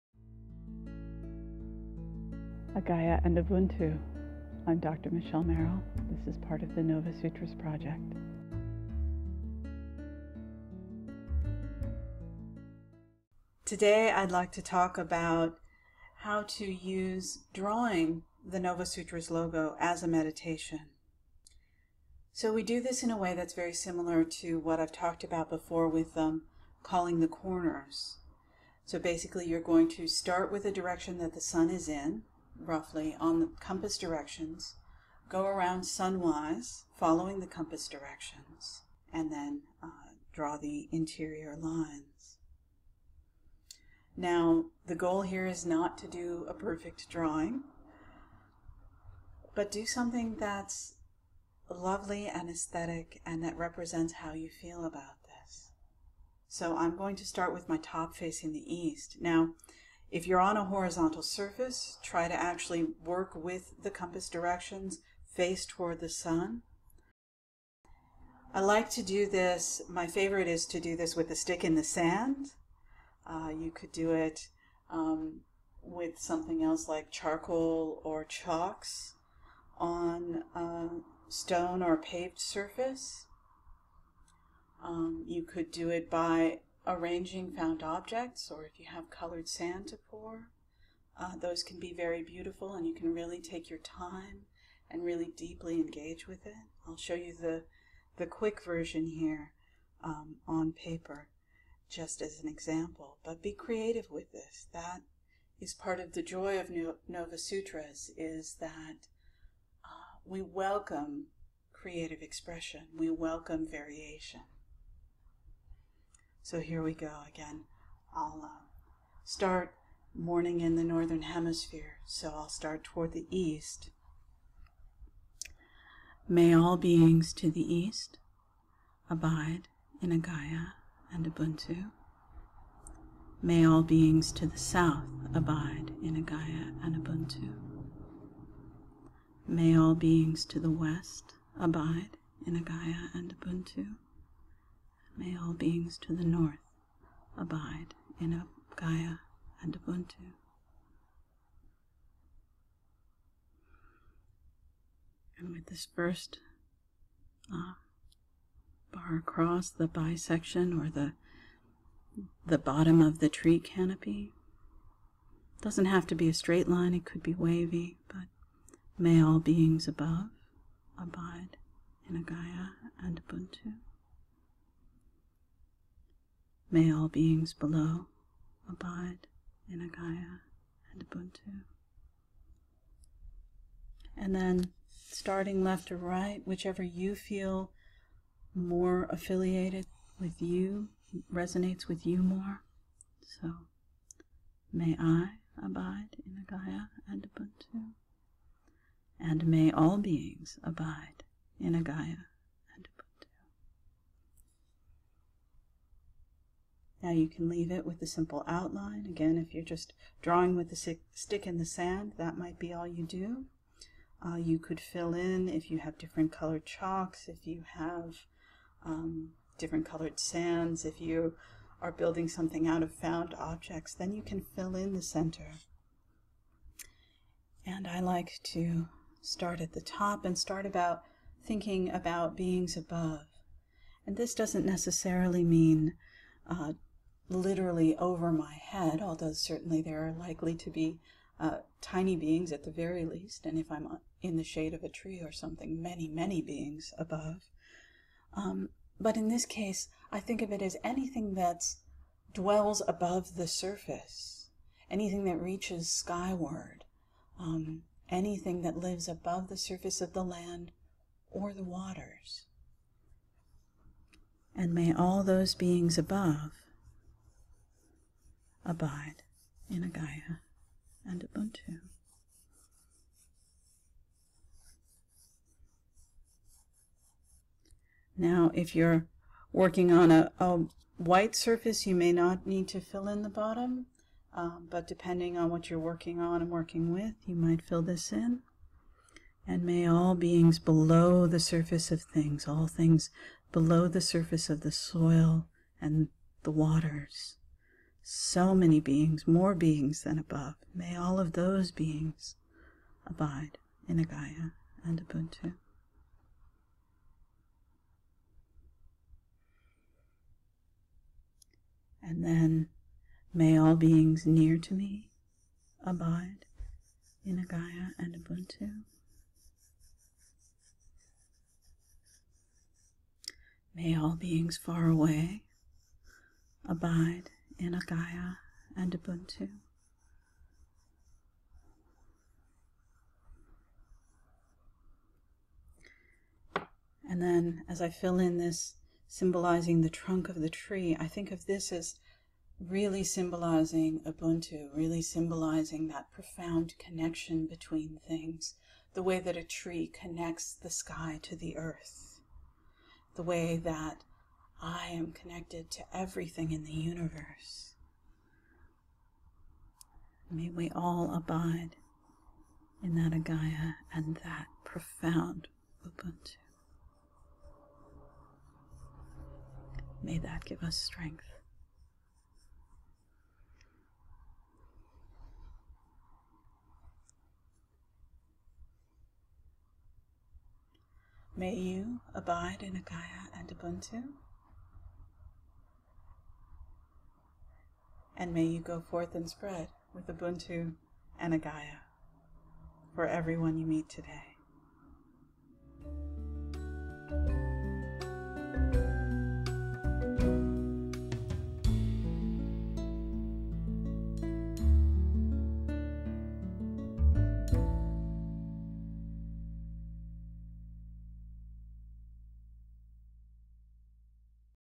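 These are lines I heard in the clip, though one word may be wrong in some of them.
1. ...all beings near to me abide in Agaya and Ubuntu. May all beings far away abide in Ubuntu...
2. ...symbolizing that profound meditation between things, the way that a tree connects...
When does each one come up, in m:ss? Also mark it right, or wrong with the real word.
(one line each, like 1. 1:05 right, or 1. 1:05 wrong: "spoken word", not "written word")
1. 5:13 wrong: "Agaya", not "Ubuntu"
2. 5:45 wrong: "connection", not "meditation".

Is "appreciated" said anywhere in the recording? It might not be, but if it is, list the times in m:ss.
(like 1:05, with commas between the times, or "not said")
not said.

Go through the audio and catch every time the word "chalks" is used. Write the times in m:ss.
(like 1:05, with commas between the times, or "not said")
1:18, 3:36.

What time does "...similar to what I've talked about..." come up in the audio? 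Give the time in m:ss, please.
0:23.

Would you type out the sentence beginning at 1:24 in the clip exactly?
Um, you could do it by arranging found objects or if you have colored sand to pour.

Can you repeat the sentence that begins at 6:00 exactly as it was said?
May we all abide in that Agaya and that profound Ubuntu.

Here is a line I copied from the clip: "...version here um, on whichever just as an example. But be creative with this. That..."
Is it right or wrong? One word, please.
wrong.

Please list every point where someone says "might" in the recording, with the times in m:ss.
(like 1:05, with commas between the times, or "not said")
3:32, 4:47.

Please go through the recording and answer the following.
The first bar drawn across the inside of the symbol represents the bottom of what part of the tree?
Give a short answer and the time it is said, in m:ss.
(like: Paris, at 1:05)
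the tree canopy, at 2:43.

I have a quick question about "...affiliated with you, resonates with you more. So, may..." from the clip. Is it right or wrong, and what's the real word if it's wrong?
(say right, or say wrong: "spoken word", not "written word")
right.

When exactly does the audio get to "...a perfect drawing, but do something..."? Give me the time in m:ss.
0:46.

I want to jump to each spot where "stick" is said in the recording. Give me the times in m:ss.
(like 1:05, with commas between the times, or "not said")
1:11, 3:30.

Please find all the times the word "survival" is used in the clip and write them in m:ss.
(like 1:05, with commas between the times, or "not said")
not said.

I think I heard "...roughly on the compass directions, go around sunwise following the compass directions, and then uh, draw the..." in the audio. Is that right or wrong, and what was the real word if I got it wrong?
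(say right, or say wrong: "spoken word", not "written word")
right.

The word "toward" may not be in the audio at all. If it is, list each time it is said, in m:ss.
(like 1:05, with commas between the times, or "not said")
1:05, 2:02.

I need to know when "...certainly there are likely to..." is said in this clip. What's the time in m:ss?
3:59.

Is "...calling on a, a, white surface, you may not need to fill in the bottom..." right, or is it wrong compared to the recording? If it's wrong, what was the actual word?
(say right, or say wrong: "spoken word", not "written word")
wrong: "working", not "calling".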